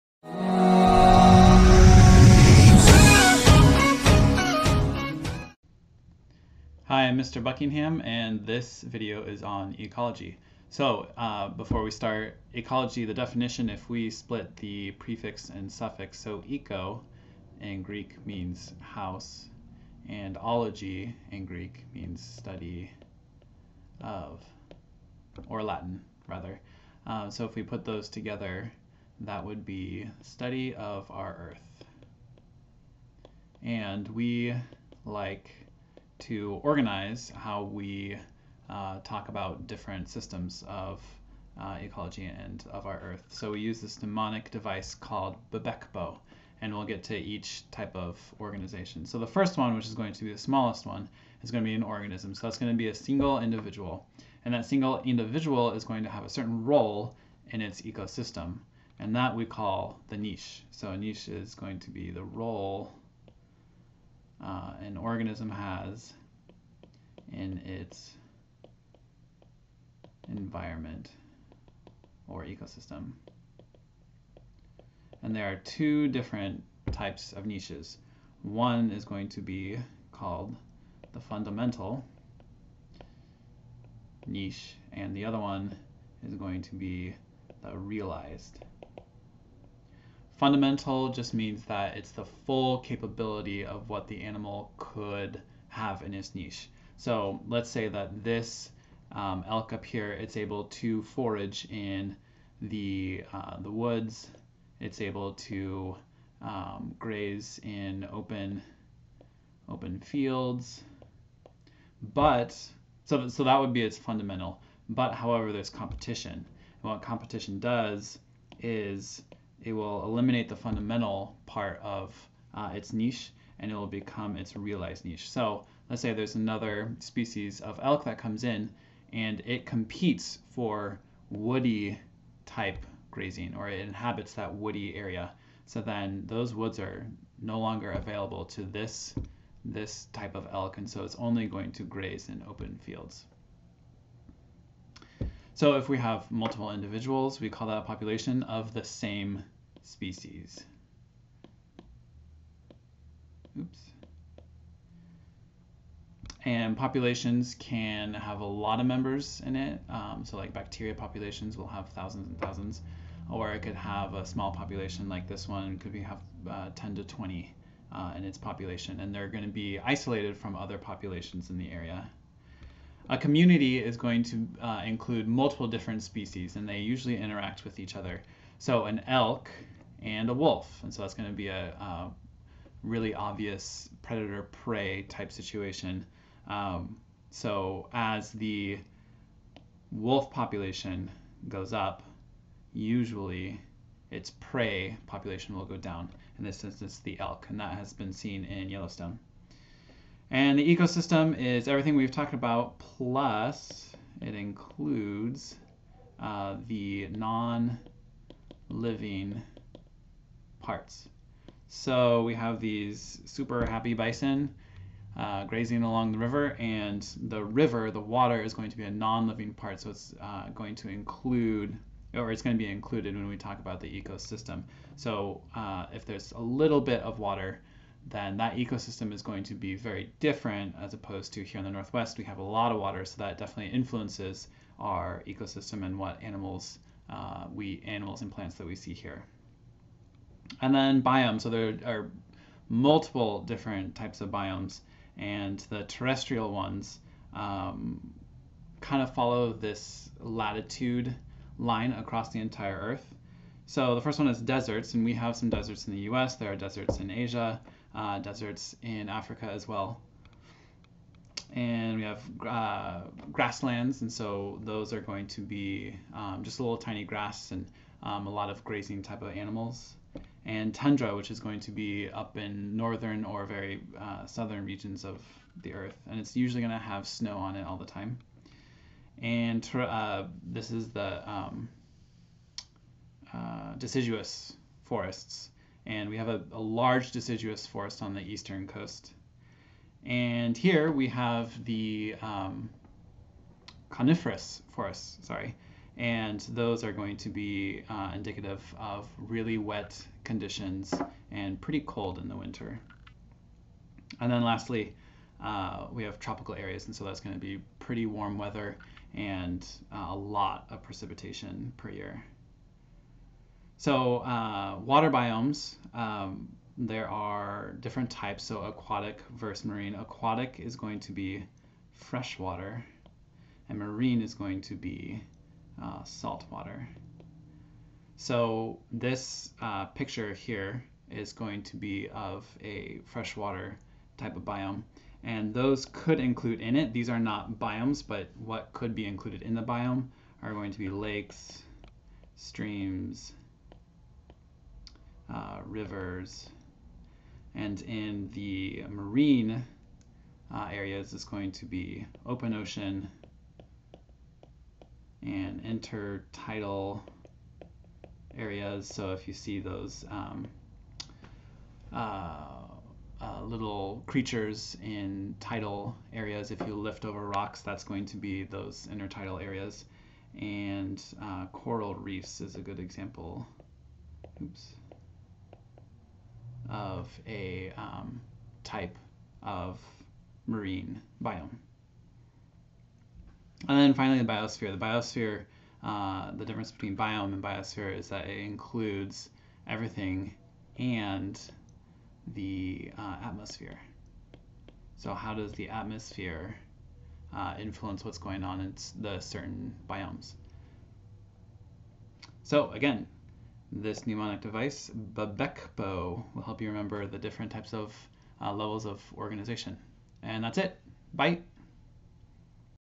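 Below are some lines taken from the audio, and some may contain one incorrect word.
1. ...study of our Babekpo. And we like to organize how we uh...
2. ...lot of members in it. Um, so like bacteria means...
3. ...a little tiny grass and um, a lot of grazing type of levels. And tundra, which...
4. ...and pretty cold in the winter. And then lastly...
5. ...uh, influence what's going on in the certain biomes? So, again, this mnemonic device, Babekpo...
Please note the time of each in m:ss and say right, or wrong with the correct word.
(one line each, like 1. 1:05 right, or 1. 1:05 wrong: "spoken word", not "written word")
1. 0:30 wrong: "Earth", not "Babekpo"
2. 2:38 wrong: "populations", not "means"
3. 4:26 wrong: "animals", not "levels"
4. 5:01 right
5. 6:37 right.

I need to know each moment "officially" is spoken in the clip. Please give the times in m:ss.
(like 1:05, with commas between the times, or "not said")
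not said.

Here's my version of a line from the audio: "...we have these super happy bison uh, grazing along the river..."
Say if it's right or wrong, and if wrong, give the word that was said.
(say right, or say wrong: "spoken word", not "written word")
right.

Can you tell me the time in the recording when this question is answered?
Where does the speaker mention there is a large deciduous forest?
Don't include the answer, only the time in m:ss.
4:48.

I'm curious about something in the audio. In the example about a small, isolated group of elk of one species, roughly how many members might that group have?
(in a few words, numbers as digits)
10 to 20.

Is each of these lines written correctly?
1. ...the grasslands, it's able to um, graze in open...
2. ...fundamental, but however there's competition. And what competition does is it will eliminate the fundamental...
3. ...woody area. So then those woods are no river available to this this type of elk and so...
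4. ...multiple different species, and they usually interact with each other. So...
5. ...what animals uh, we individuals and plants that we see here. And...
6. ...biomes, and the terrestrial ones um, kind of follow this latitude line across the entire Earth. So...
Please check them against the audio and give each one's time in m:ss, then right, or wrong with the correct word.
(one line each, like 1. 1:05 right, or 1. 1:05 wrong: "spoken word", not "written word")
1. 1:43 wrong: "woods", not "grasslands"
2. 1:53 right
3. 2:14 wrong: "longer", not "river"
4. 2:55 right
5. 3:55 wrong: "animals", not "individuals"
6. 4:04 right.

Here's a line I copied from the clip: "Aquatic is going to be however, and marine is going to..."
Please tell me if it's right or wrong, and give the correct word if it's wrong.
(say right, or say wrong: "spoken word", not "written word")
wrong: "freshwater", not "however".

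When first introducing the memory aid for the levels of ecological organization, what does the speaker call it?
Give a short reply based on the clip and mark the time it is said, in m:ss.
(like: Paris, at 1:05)
Bebekbo, at 0:45.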